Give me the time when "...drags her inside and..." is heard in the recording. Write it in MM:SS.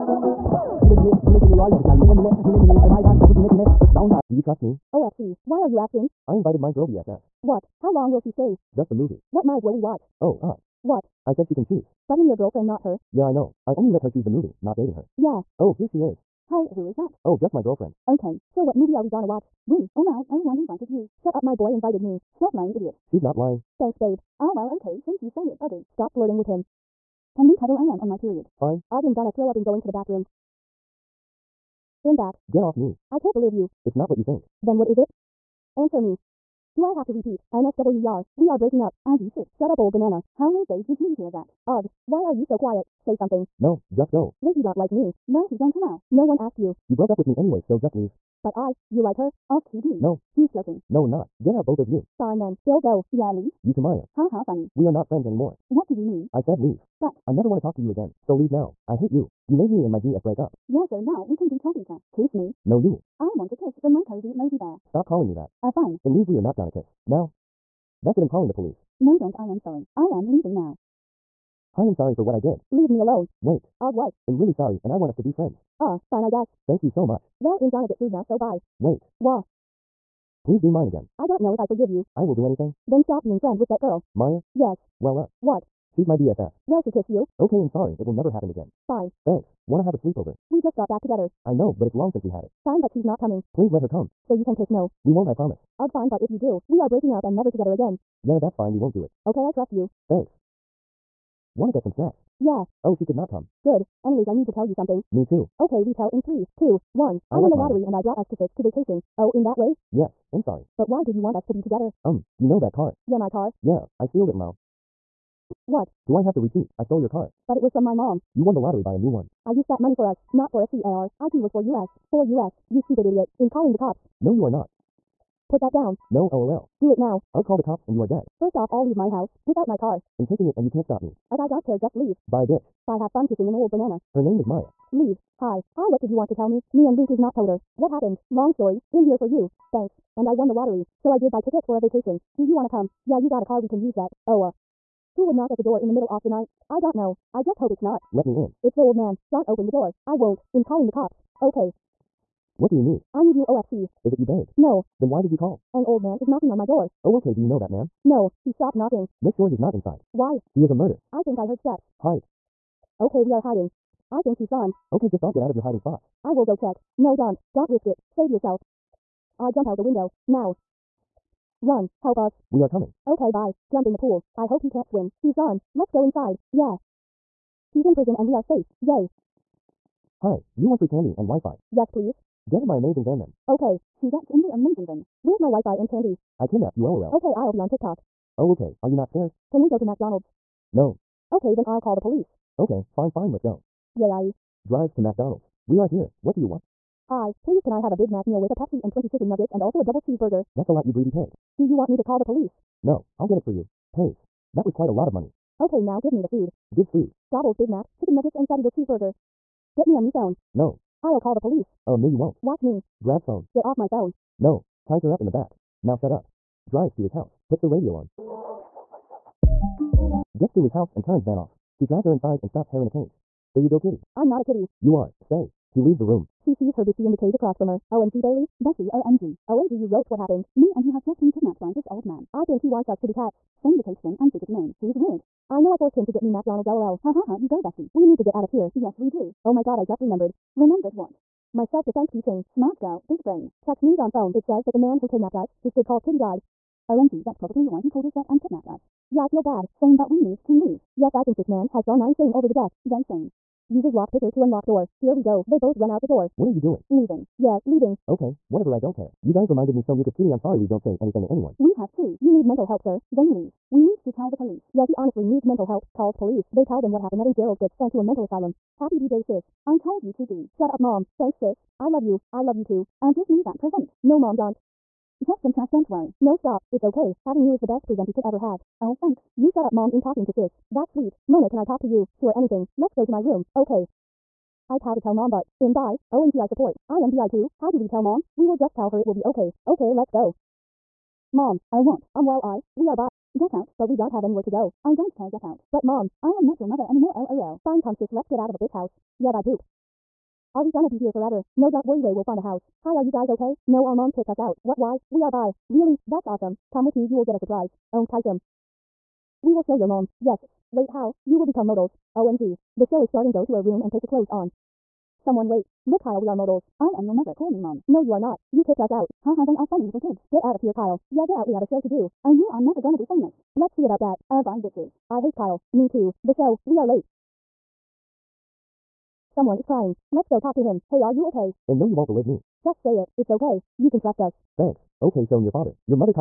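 03:41.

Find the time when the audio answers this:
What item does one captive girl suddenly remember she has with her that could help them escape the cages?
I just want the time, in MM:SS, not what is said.
04:01.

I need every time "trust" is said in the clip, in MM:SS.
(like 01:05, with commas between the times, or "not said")
00:04, 01:39, 05:33.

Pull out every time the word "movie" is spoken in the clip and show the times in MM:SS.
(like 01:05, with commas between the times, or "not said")
00:08, 00:14, 00:18.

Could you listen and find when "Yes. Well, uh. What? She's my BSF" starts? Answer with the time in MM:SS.
01:24.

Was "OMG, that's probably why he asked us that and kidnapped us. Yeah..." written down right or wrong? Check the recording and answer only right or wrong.
wrong.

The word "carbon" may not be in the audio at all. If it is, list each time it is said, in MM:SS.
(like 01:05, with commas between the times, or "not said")
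not said.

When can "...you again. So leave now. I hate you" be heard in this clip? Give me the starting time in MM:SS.
00:57.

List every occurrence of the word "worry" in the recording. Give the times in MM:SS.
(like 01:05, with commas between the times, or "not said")
04:35, 05:01.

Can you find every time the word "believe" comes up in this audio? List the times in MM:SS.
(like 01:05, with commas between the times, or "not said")
00:33, 05:32.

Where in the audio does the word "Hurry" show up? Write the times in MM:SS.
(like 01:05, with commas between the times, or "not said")
not said.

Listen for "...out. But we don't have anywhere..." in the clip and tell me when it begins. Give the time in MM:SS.
04:53.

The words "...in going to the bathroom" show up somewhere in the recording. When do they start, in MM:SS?
00:29.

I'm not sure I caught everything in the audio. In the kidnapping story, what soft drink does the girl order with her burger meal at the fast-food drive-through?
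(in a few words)
Pepsi.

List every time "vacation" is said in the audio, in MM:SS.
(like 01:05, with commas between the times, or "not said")
01:48, 02:21.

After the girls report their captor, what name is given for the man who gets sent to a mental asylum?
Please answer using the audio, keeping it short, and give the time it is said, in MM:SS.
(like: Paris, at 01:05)
Gerald, at 04:27.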